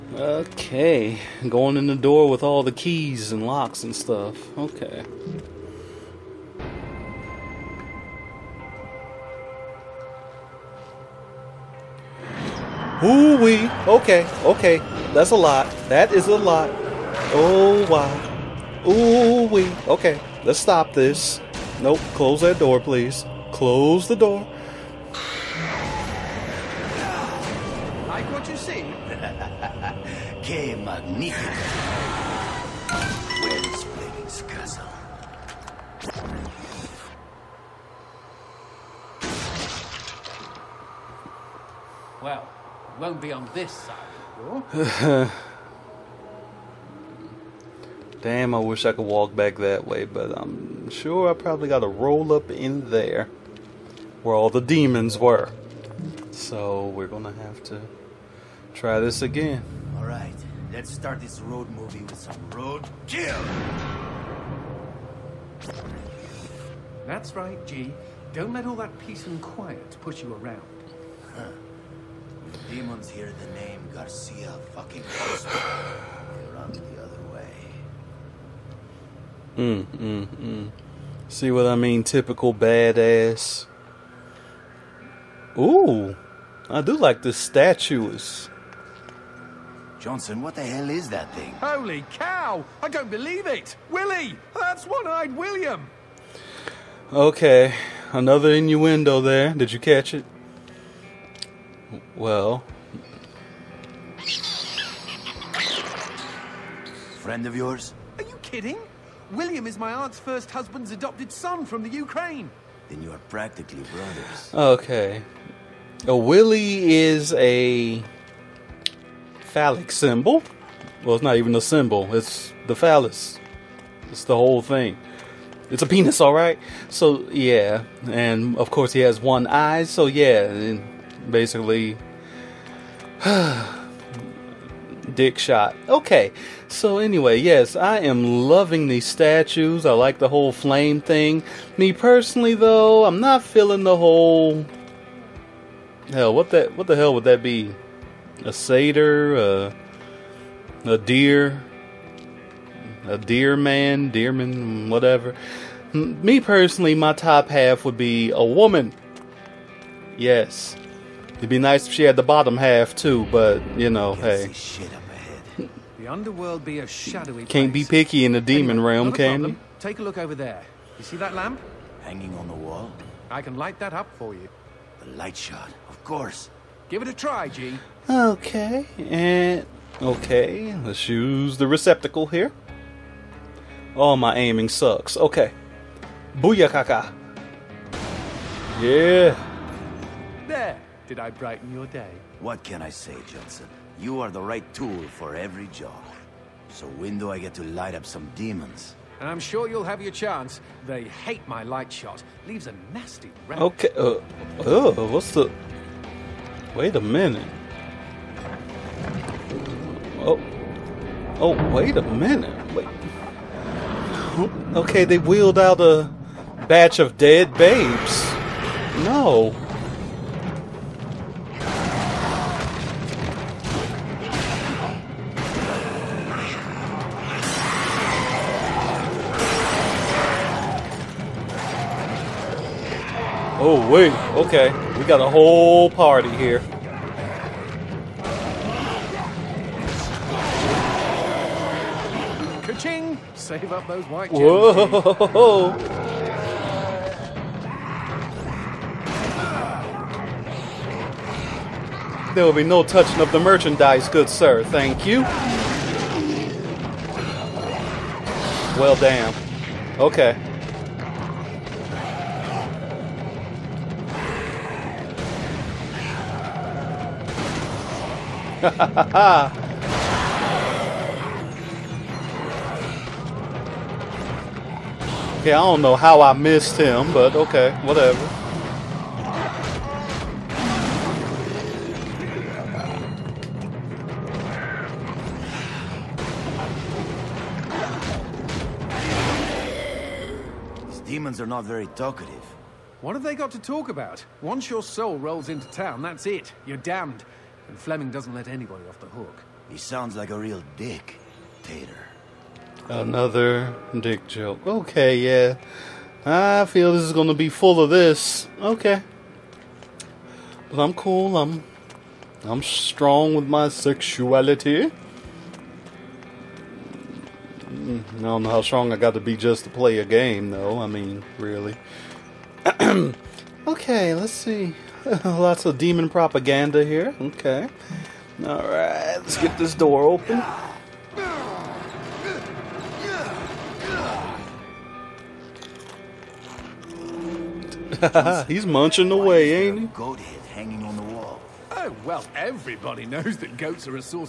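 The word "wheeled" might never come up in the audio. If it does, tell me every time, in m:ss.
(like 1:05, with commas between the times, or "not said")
3:35.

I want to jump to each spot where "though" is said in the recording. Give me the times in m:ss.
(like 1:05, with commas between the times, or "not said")
2:22, 5:20.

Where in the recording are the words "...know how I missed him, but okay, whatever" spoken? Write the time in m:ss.
4:35.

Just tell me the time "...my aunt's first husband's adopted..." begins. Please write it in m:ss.
1:49.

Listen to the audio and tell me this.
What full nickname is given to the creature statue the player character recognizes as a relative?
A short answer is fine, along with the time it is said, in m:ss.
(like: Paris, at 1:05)
One eyed William, at 1:34.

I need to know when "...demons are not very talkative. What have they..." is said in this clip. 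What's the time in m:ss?
4:51.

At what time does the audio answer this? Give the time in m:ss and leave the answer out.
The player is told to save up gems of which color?
4:04.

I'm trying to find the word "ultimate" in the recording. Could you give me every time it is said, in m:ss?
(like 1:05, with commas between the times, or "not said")
not said.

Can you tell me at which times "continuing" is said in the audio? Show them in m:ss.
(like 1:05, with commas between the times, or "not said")
not said.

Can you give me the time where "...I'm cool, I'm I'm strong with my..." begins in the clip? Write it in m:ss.
5:10.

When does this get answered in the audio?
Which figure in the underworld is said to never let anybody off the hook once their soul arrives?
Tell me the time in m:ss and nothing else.
4:57.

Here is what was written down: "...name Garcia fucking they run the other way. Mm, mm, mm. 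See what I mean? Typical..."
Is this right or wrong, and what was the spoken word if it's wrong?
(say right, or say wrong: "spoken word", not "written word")
right.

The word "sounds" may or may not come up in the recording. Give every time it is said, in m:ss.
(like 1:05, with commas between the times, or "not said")
4:59.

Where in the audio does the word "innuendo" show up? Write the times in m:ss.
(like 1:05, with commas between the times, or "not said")
1:38.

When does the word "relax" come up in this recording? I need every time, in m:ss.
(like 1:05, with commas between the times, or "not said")
not said.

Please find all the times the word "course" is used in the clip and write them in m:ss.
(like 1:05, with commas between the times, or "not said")
2:08, 2:56.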